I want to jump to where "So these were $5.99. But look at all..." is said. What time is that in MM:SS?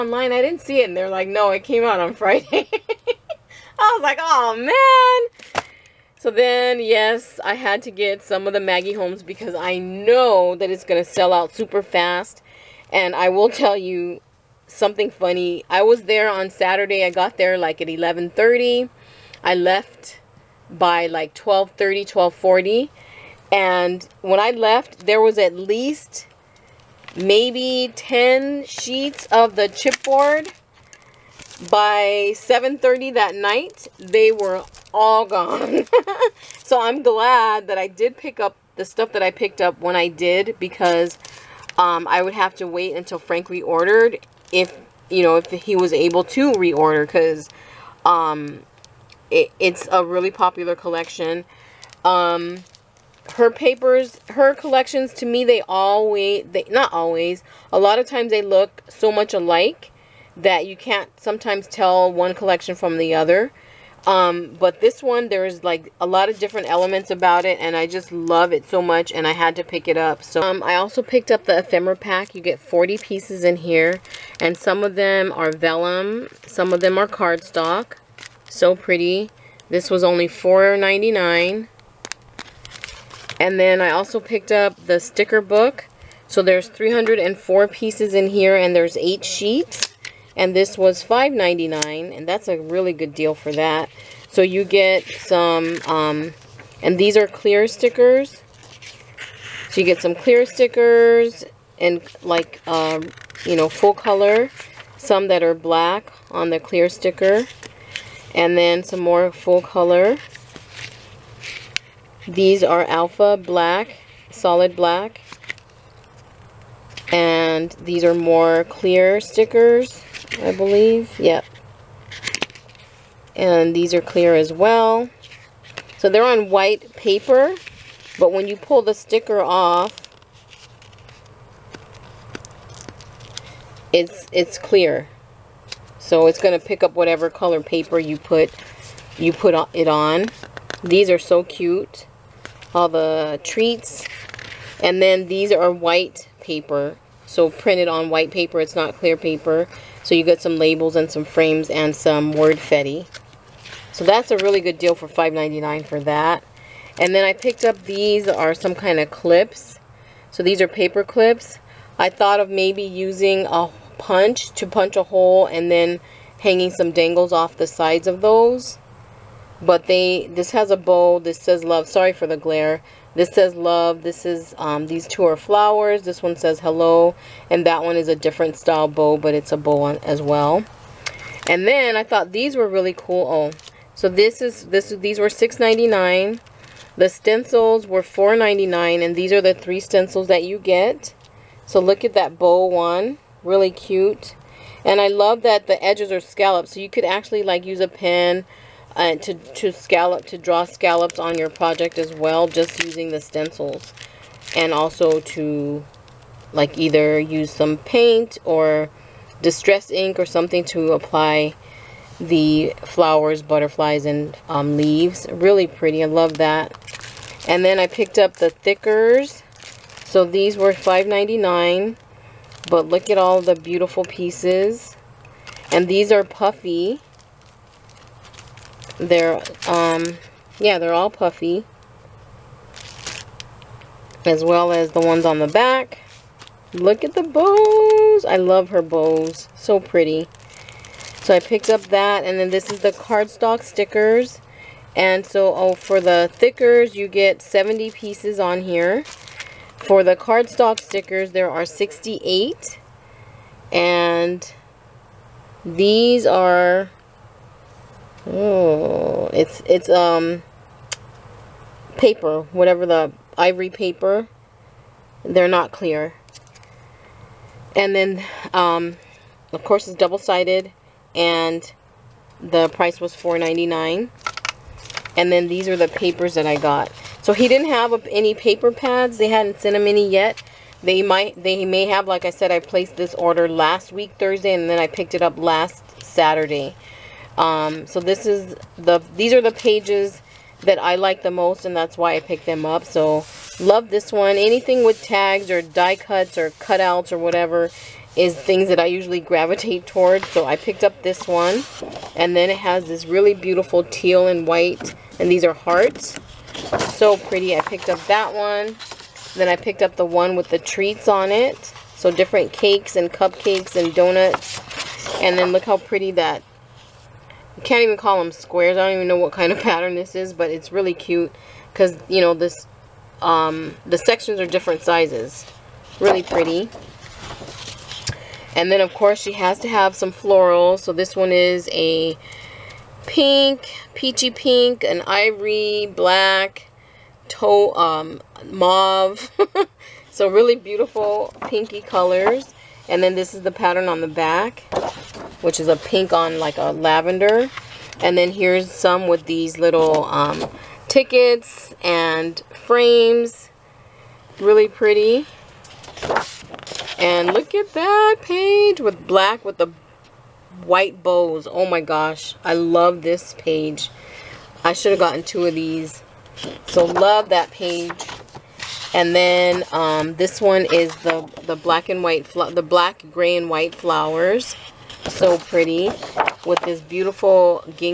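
03:40.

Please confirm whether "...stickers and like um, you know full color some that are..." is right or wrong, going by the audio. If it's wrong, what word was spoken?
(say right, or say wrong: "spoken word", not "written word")
right.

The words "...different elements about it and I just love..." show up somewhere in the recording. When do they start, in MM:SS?
01:06.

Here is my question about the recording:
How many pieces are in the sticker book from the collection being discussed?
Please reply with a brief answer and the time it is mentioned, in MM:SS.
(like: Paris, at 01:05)
304, at 01:26.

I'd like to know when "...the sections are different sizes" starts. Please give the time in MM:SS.
05:23.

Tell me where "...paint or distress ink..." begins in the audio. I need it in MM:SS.
03:27.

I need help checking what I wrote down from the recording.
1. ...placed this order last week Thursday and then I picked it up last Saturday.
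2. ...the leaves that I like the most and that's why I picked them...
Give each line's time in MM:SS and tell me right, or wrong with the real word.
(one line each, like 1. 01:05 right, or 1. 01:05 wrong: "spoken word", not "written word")
1. 04:42 right
2. 04:49 wrong: "pages", not "leaves".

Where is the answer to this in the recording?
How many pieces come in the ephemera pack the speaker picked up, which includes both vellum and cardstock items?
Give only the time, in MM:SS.
01:12.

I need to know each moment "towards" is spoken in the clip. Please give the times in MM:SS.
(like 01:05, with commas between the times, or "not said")
04:59.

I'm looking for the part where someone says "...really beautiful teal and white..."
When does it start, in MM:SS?
05:03.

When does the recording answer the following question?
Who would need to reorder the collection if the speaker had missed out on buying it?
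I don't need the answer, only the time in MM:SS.
00:43.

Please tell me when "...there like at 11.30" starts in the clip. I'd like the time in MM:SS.
00:17.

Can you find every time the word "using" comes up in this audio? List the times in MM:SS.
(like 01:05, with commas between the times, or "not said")
02:42, 03:22.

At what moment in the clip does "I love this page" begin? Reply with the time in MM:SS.
06:02.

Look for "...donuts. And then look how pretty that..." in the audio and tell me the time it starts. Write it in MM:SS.
05:13.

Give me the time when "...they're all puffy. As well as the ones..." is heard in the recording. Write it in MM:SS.
03:50.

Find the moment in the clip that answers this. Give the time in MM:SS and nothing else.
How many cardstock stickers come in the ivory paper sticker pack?
04:11.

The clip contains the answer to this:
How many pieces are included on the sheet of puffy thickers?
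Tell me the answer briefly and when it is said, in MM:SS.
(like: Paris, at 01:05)
70, at 04:07.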